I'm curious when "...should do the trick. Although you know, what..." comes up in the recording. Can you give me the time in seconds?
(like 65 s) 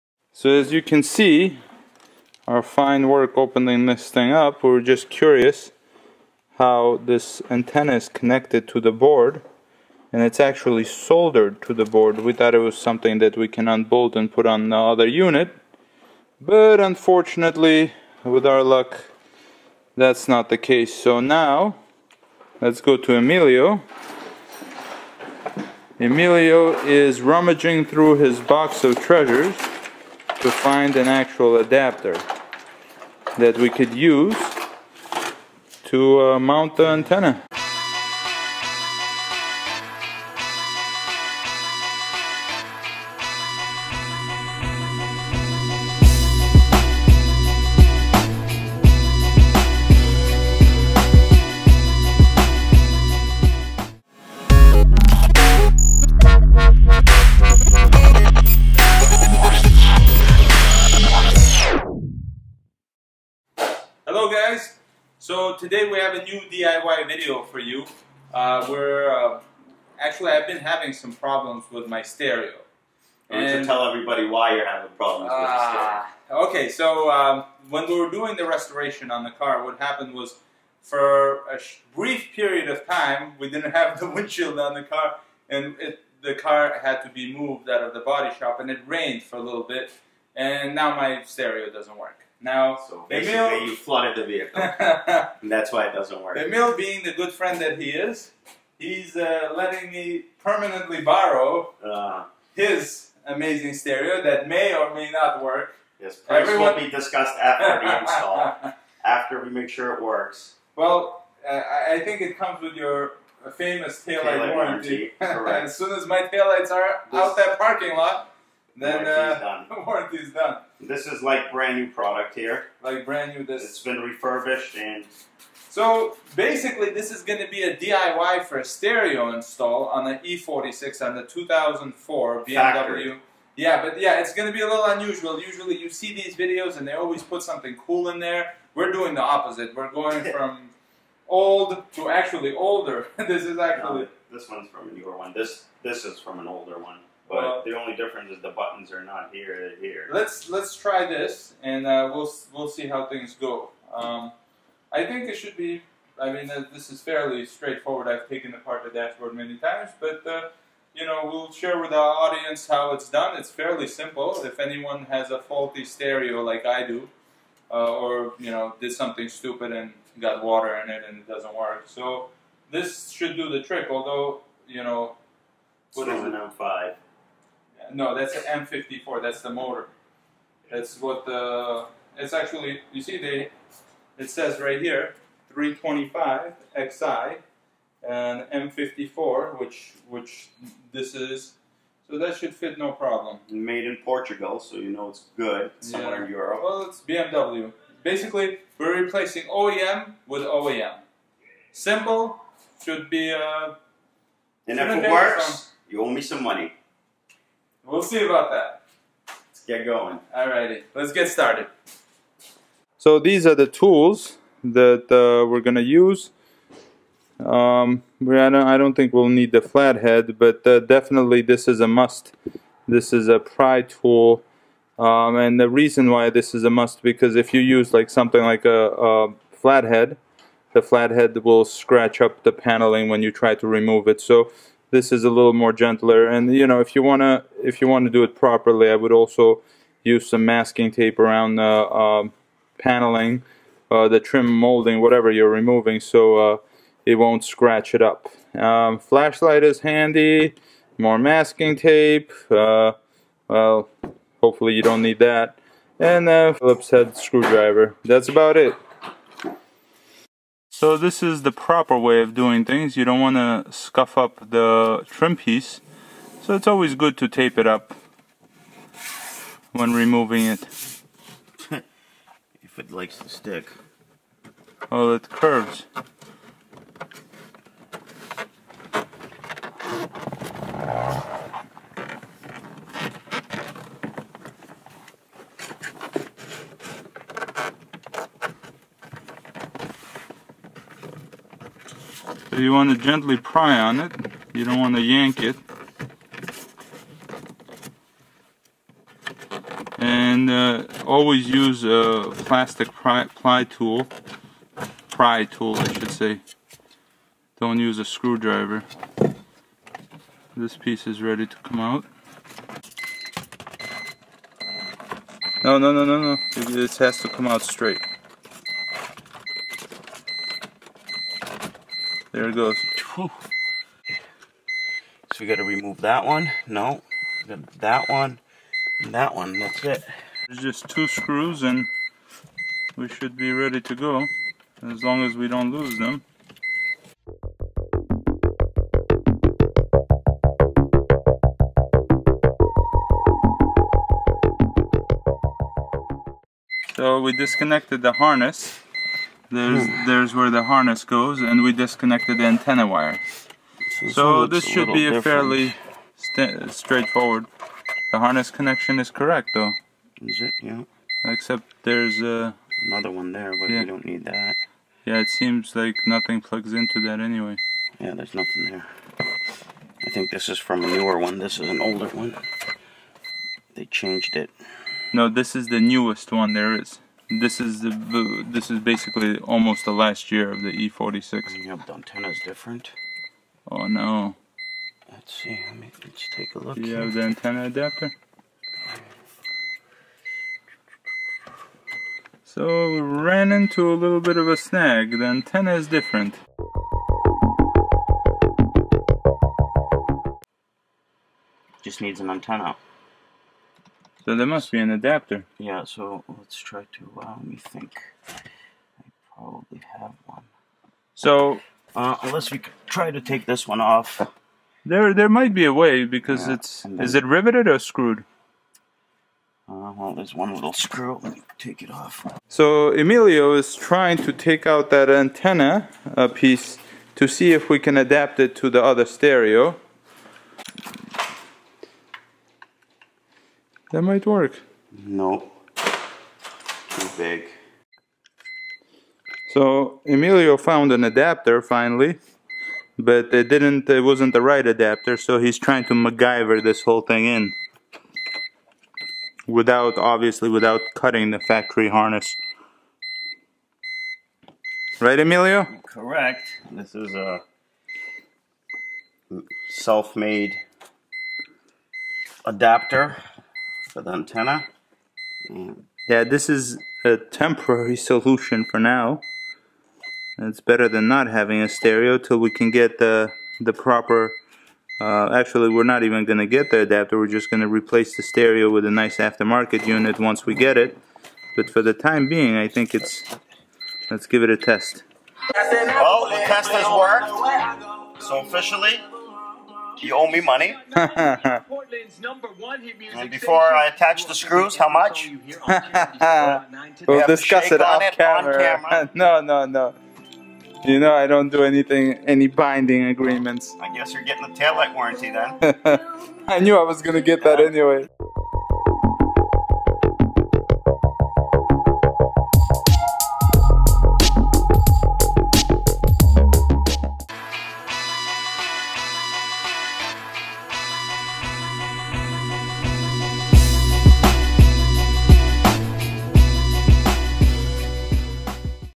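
173 s.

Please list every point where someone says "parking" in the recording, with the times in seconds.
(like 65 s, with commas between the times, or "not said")
117 s.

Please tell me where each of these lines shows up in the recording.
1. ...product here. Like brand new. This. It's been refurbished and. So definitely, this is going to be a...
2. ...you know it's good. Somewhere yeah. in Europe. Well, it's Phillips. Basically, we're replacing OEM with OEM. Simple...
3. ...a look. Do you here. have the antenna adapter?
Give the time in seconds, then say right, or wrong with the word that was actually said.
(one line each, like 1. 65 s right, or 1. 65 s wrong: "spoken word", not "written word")
1. 121 s wrong: "basically", not "definitely"
2. 194 s wrong: "BMW", not "Phillips"
3. 386 s right.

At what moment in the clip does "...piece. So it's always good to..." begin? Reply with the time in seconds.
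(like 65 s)
265 s.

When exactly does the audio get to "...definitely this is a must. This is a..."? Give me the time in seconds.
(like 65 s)
220 s.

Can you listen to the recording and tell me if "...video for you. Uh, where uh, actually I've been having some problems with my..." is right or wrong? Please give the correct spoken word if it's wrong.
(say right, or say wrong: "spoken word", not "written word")
right.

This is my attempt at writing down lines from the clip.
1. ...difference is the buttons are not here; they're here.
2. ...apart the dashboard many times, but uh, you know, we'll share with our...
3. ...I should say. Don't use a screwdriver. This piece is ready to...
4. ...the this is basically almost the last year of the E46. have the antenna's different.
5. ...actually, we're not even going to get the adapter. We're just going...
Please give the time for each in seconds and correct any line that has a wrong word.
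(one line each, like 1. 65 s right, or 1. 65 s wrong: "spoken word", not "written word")
1. 147 s right
2. 158 s right
3. 305 s right
4. 377 s right
5. 475 s right.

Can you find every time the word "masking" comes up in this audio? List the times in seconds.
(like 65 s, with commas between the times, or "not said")
240 s, 251 s.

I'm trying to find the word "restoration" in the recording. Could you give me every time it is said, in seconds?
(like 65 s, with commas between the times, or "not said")
78 s.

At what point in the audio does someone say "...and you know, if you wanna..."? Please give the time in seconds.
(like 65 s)
236 s.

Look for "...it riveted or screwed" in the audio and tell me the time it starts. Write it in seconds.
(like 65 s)
417 s.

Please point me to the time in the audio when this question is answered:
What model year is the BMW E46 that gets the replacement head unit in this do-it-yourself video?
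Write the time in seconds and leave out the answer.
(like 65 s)
131 s.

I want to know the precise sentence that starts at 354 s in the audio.
So, so this should a be a different.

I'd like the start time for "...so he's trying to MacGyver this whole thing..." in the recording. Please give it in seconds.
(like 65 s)
445 s.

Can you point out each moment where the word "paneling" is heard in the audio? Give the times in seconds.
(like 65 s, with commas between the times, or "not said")
232 s, 242 s.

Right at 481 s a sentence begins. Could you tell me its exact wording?
But for the time being, I think it's...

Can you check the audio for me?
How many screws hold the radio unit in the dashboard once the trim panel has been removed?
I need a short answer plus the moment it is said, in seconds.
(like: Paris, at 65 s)
2, at 330 s.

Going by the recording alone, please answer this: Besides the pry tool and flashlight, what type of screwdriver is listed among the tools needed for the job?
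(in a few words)
Phillips head.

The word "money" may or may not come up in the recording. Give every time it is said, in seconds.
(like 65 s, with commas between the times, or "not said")
206 s, 490 s.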